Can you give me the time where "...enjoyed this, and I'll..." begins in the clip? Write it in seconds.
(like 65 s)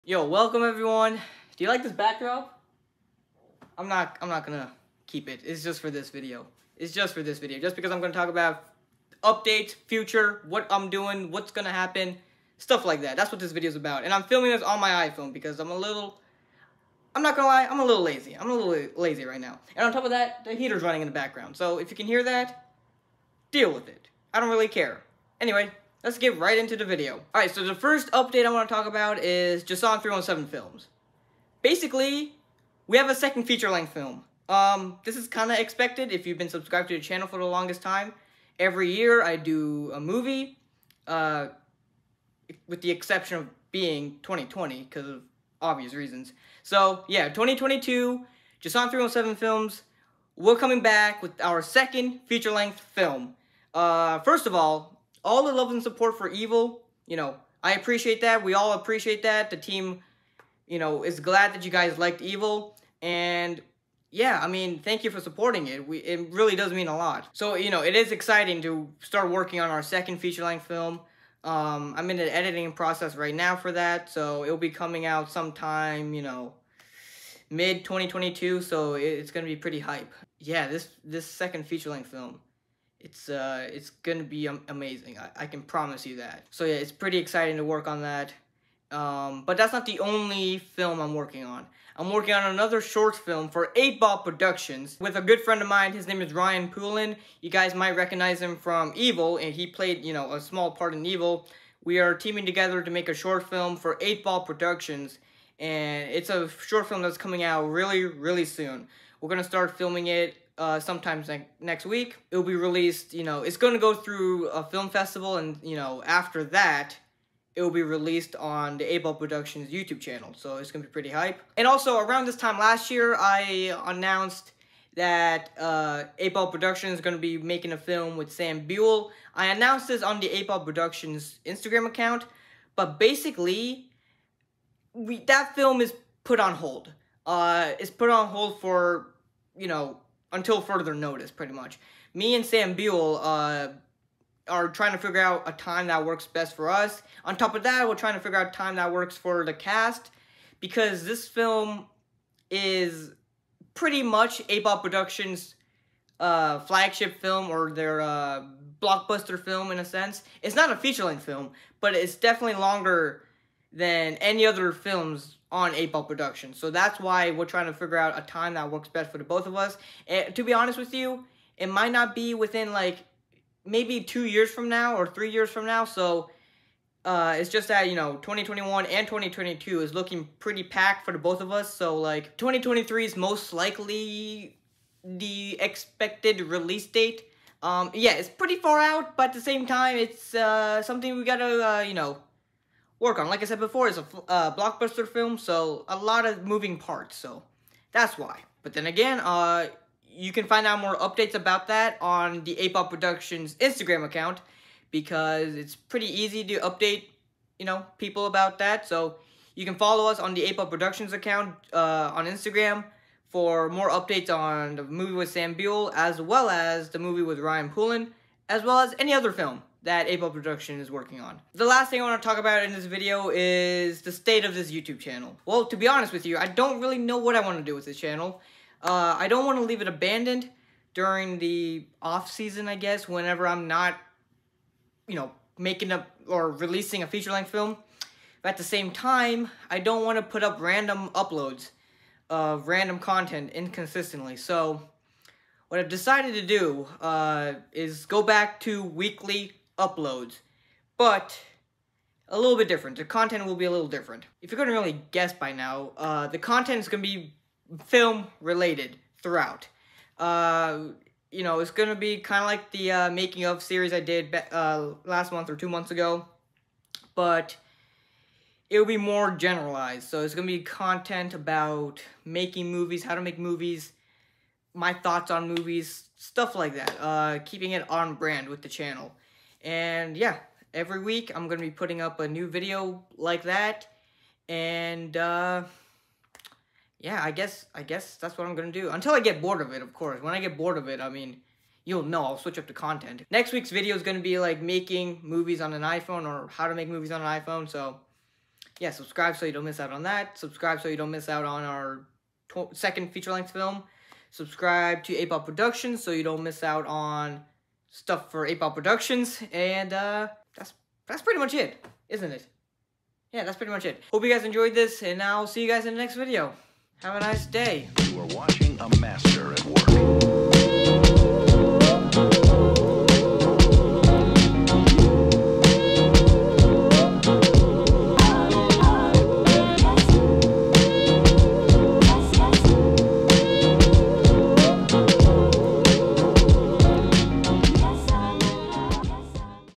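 314 s.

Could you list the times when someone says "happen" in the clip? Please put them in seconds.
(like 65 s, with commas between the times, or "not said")
11 s.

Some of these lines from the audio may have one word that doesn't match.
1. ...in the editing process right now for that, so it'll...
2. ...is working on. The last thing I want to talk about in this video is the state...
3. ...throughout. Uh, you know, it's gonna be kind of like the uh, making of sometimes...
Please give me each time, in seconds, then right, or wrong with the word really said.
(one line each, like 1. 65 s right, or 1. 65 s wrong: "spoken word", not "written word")
1. 72 s right
2. 220 s right
3. 259 s wrong: "series", not "sometimes".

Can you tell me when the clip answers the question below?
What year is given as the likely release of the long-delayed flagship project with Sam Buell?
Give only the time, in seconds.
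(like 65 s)
182 s.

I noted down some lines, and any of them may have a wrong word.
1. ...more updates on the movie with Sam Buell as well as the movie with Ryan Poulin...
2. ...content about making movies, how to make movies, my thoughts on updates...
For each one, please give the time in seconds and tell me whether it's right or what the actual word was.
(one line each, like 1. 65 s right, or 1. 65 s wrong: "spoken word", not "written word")
1. 213 s right
2. 270 s wrong: "movies", not "updates".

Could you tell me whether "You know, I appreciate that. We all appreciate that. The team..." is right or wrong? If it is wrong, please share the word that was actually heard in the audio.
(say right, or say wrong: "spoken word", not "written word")
right.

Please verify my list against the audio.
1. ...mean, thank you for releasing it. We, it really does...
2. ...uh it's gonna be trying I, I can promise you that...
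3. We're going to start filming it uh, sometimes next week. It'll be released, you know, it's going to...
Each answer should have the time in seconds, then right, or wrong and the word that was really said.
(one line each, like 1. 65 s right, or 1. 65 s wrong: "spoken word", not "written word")
1. 64 s wrong: "supporting", not "releasing"
2. 83 s wrong: "amazing", not "trying"
3. 109 s right.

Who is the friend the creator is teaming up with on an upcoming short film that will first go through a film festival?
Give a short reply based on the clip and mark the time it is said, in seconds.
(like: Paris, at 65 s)
Ryan Poolin, at 96 s.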